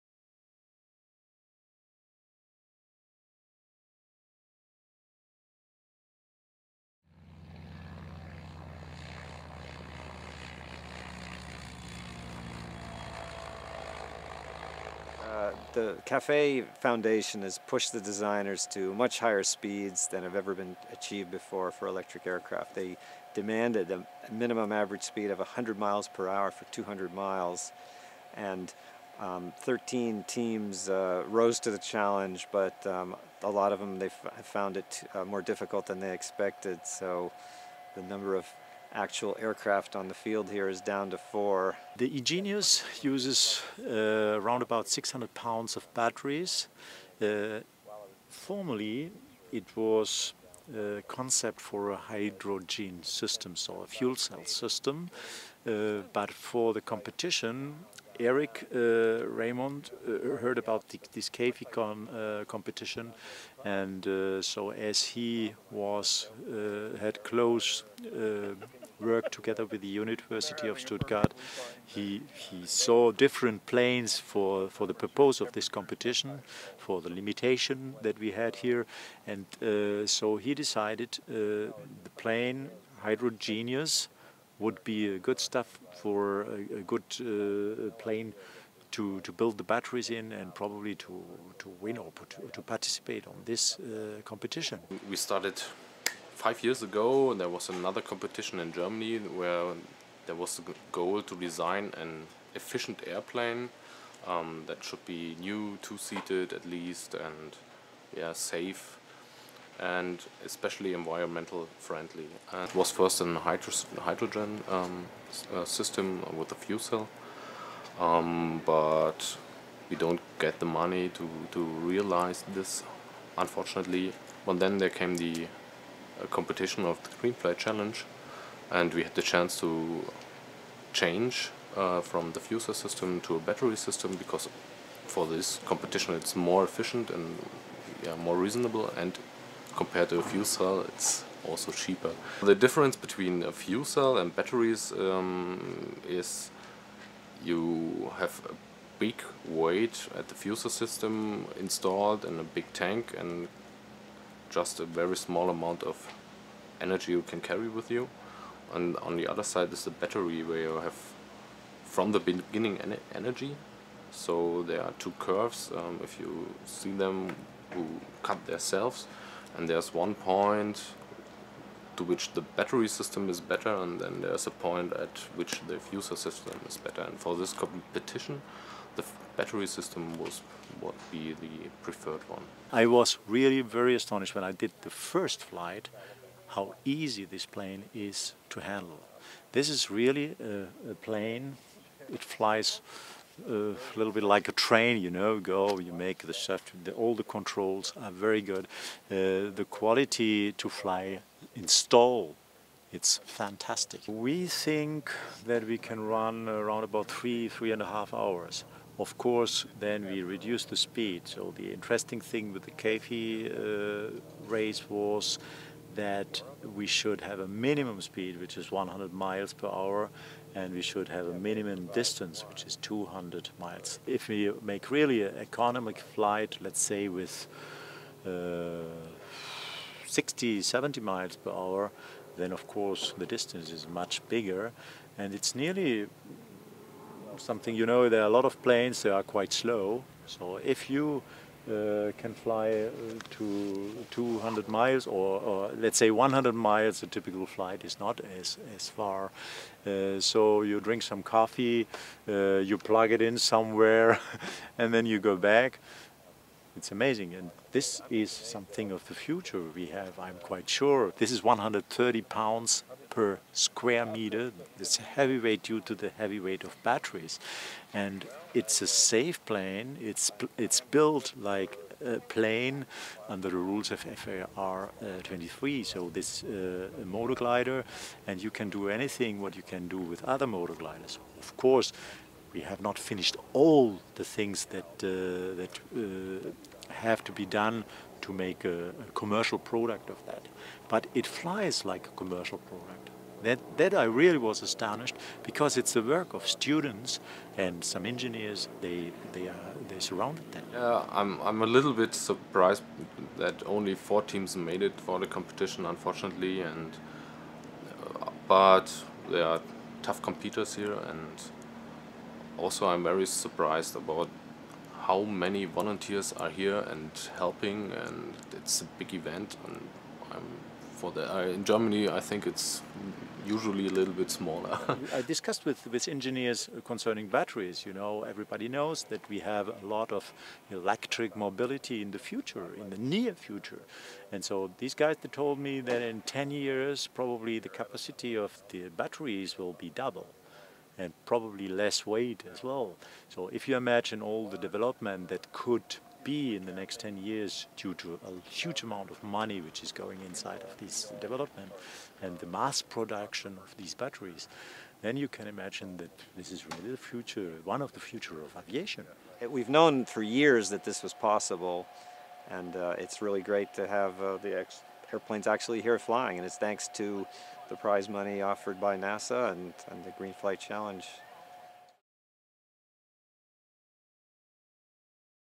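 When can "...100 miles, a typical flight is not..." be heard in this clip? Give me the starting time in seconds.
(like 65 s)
246 s.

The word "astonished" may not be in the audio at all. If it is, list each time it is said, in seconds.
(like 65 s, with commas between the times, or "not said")
183 s, 294 s.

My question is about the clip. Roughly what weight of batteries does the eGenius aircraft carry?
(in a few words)
600 pounds.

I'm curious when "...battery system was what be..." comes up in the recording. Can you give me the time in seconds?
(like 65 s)
179 s.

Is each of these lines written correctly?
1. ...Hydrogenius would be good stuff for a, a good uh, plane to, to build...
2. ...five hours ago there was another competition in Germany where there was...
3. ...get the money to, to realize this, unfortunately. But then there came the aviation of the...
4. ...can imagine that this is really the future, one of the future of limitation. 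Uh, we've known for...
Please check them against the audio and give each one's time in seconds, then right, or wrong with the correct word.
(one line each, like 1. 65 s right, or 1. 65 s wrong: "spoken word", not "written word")
1. 83 s right
2. 96 s wrong: "years", not "hours"
3. 120 s wrong: "competition", not "aviation"
4. 355 s wrong: "aviation", not "limitation".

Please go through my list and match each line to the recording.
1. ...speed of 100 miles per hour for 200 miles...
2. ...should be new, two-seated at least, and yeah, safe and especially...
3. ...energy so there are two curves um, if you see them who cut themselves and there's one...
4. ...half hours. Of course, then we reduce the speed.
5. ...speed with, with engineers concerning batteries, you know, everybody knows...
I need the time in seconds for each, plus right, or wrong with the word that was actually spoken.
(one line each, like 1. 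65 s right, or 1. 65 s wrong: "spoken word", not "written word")
1. 25 s right
2. 104 s right
3. 163 s right
4. 207 s right
5. 325 s wrong: "discussed", not "speed".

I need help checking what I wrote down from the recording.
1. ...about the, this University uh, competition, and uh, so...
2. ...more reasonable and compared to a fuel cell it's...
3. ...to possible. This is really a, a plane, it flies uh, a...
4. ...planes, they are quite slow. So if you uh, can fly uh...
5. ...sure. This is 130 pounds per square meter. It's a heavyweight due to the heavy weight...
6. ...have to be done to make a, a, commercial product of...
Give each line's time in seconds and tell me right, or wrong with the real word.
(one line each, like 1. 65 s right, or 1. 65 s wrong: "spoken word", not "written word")
1. 60 s wrong: "KFICON", not "University"
2. 138 s right
3. 188 s wrong: "handle", not "possible"
4. 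238 s right
5. 260 s right
6. 286 s right.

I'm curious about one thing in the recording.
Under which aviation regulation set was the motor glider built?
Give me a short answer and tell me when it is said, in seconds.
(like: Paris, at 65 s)
FAR 23, at 273 s.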